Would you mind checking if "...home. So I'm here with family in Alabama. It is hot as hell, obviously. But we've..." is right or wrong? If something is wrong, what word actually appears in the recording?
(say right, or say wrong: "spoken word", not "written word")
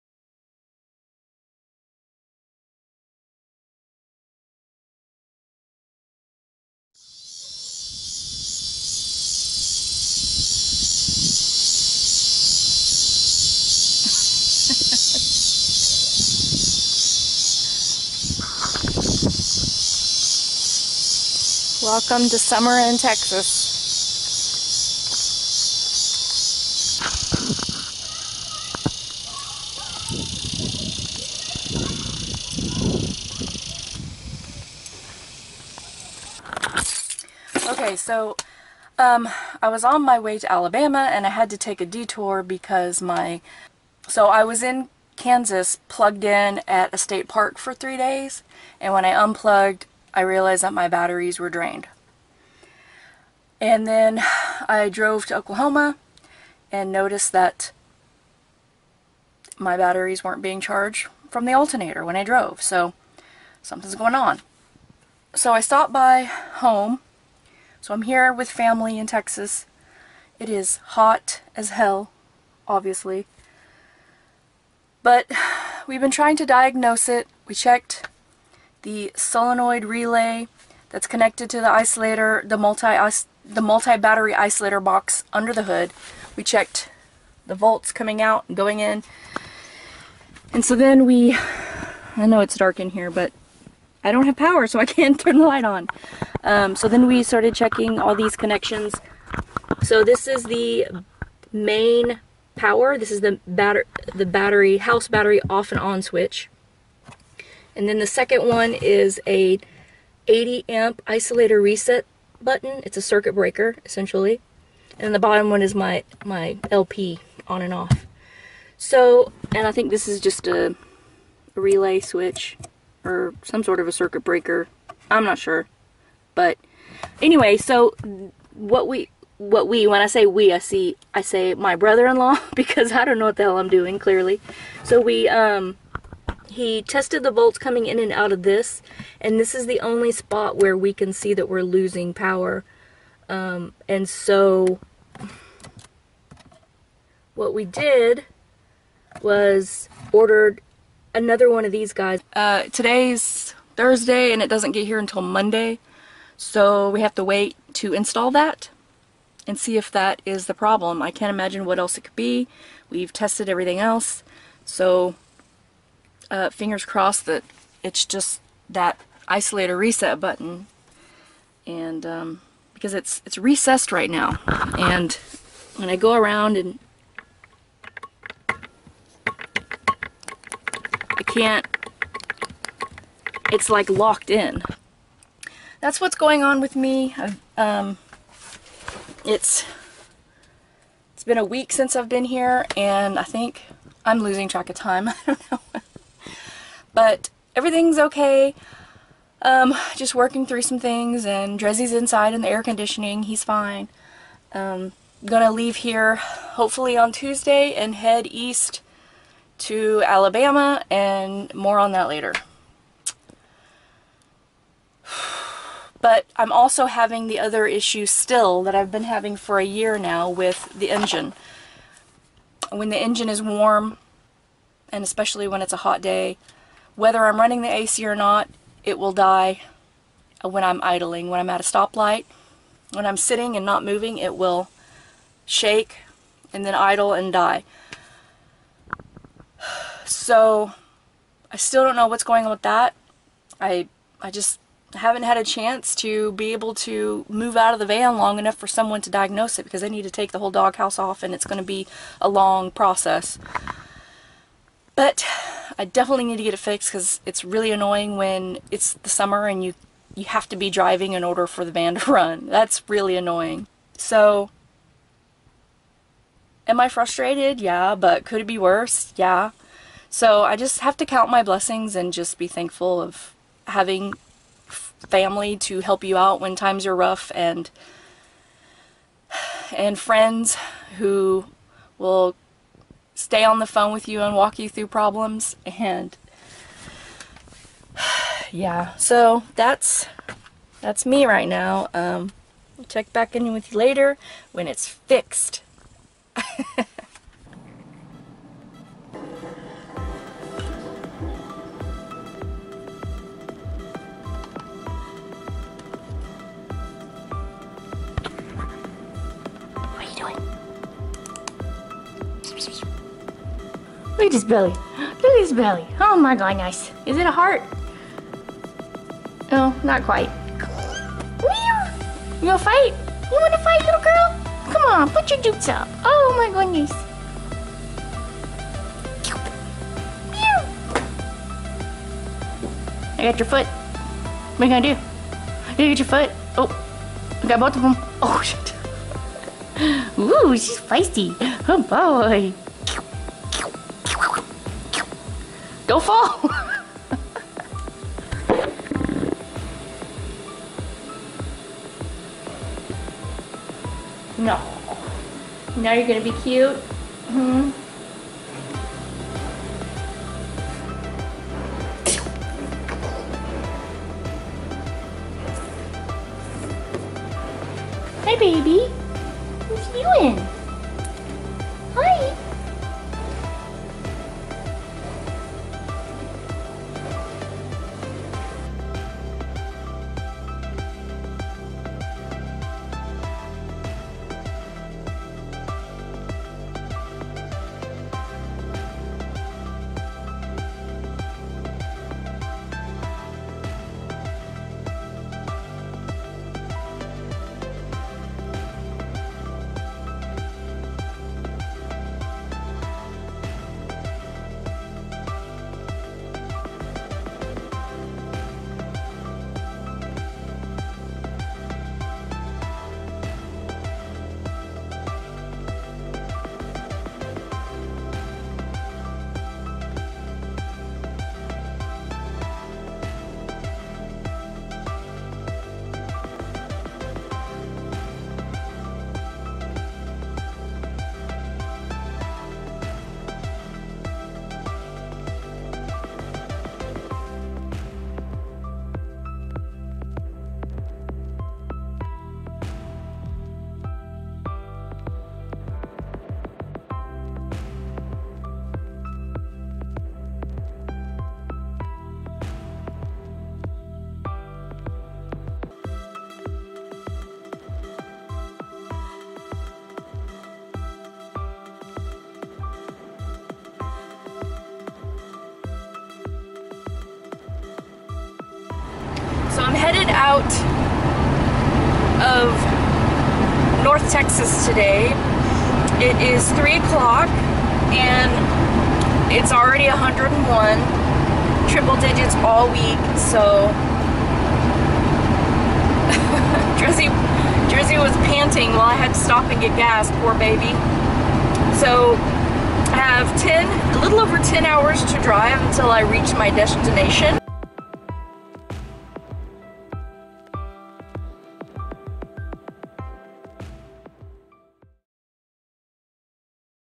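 wrong: "Texas", not "Alabama".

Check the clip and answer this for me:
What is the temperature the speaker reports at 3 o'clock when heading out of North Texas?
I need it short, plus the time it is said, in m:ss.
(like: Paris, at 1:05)
101, at 7:59.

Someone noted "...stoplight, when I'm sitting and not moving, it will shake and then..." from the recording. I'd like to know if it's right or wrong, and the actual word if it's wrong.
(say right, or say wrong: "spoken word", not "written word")
right.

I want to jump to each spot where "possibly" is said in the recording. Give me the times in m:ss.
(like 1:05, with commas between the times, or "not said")
not said.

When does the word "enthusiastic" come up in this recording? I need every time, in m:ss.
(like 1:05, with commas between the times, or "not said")
not said.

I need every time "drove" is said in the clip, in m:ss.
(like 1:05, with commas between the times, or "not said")
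0:54, 1:02.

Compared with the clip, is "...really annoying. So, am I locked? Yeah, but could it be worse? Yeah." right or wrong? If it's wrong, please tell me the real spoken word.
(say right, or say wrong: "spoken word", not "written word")
wrong: "frustrated", not "locked".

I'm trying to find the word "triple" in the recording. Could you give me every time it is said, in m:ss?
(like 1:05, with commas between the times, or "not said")
8:01.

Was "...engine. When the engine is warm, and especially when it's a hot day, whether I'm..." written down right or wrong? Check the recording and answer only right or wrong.
right.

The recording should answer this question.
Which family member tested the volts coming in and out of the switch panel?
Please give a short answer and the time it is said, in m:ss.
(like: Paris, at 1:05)
brother-in-law, at 2:11.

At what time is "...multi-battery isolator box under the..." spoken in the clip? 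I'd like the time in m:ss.
1:23.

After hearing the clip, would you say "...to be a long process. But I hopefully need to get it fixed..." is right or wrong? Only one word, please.
wrong.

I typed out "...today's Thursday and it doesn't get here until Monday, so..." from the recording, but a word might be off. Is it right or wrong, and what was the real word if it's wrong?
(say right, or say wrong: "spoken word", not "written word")
right.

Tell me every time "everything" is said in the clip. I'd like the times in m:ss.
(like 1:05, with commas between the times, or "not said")
2:43, 3:17.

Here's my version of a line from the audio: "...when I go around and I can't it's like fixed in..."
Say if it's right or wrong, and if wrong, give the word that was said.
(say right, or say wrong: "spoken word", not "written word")
wrong: "locked", not "fixed".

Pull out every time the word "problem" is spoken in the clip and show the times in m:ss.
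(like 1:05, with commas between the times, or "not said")
2:40, 4:44.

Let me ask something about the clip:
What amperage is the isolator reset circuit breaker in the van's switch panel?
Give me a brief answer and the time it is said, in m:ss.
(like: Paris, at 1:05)
80 amp, at 1:50.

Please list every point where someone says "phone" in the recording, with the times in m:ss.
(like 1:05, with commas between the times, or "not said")
4:43.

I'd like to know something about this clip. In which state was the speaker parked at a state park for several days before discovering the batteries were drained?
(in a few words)
Kansas.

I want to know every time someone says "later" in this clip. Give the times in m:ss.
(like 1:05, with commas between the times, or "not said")
3:32, 4:53.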